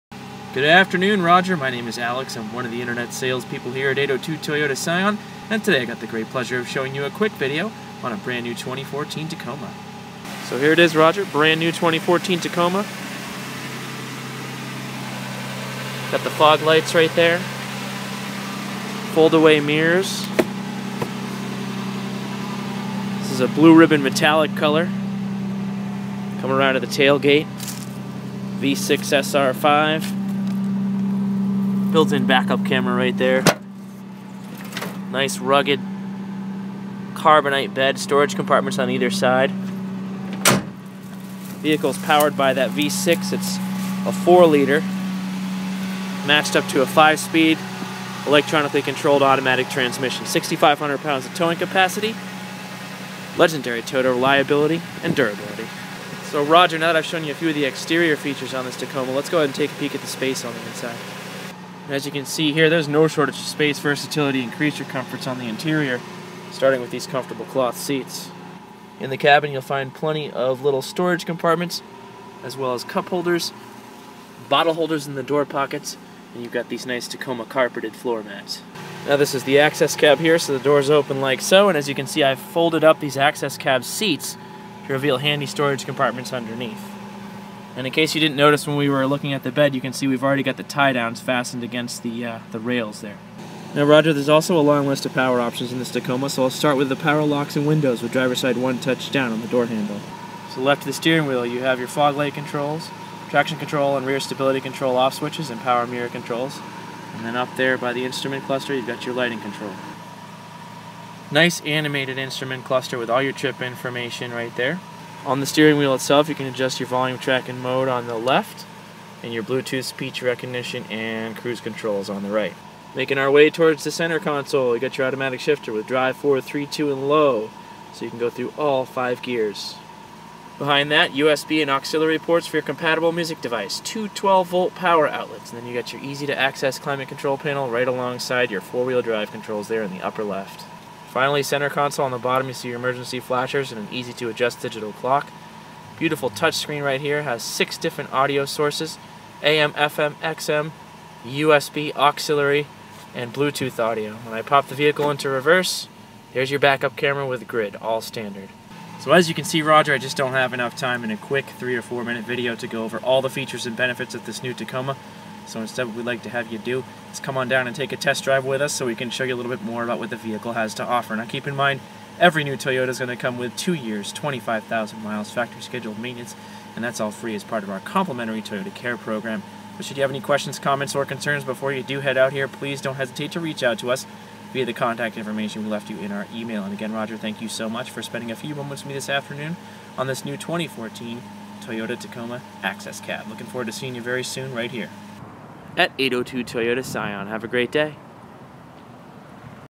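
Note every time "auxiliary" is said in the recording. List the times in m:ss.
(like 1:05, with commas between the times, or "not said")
2:11, 2:31.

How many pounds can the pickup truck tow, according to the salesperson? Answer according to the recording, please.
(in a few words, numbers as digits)
6,500 pounds.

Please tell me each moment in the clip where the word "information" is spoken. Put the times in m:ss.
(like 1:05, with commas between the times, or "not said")
1:53, 3:05.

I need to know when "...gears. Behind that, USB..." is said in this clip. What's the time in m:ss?
2:09.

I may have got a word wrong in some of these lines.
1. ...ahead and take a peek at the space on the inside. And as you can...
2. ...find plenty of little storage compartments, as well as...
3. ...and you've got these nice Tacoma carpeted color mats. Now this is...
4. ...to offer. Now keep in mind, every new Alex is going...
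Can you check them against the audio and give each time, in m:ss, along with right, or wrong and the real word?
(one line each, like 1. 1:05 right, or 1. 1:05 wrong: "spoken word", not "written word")
1. 0:59 right
2. 1:09 right
3. 1:16 wrong: "floor", not "color"
4. 2:50 wrong: "Toyota", not "Alex".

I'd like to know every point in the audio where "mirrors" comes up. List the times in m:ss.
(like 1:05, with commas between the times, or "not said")
0:19, 1:45.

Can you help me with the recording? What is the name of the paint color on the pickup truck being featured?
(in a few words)
Blue ribbon metallic.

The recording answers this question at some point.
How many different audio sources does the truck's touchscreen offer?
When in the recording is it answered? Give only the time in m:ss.
2:27.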